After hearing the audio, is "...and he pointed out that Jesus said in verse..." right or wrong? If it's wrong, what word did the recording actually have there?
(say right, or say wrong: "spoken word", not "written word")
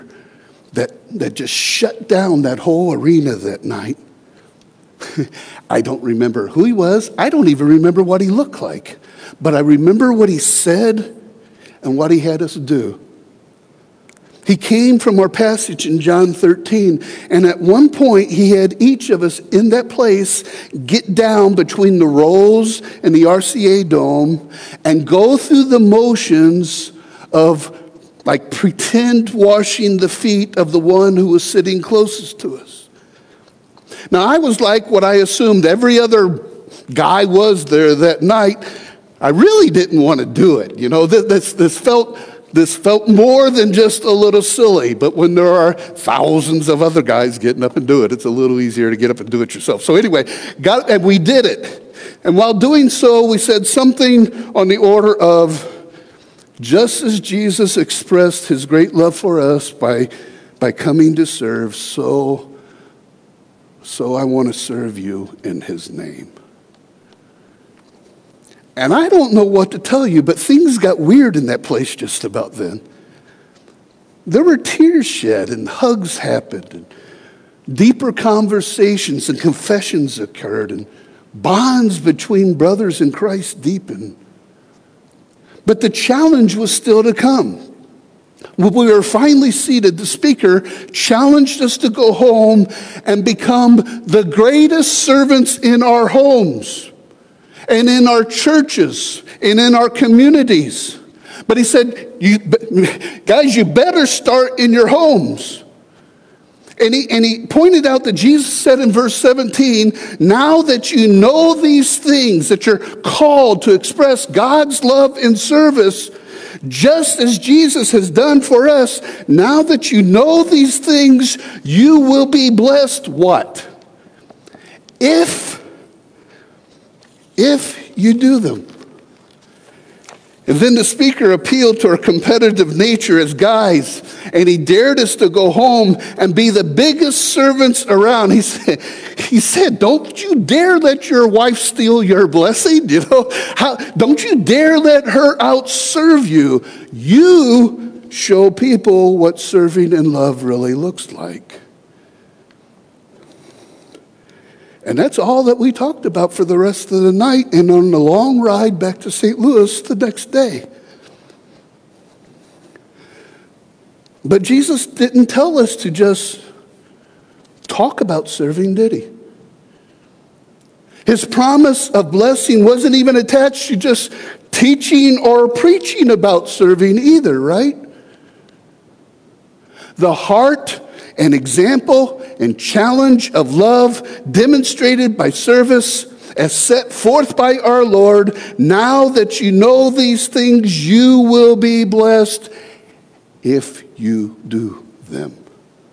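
right.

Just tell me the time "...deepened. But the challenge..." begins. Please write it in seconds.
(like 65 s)
83 s.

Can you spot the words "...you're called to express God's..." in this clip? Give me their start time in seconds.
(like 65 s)
112 s.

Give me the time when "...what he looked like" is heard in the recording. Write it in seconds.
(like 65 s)
8 s.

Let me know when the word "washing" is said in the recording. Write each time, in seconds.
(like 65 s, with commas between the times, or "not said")
29 s.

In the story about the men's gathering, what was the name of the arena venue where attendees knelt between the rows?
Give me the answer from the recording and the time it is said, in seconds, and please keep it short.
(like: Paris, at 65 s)
RCA Dome, at 23 s.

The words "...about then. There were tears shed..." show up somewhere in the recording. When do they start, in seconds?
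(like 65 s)
72 s.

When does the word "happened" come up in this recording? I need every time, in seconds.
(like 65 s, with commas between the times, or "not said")
76 s.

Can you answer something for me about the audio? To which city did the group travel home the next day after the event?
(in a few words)
St. Louis.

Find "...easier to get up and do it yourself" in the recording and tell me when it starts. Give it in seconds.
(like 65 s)
48 s.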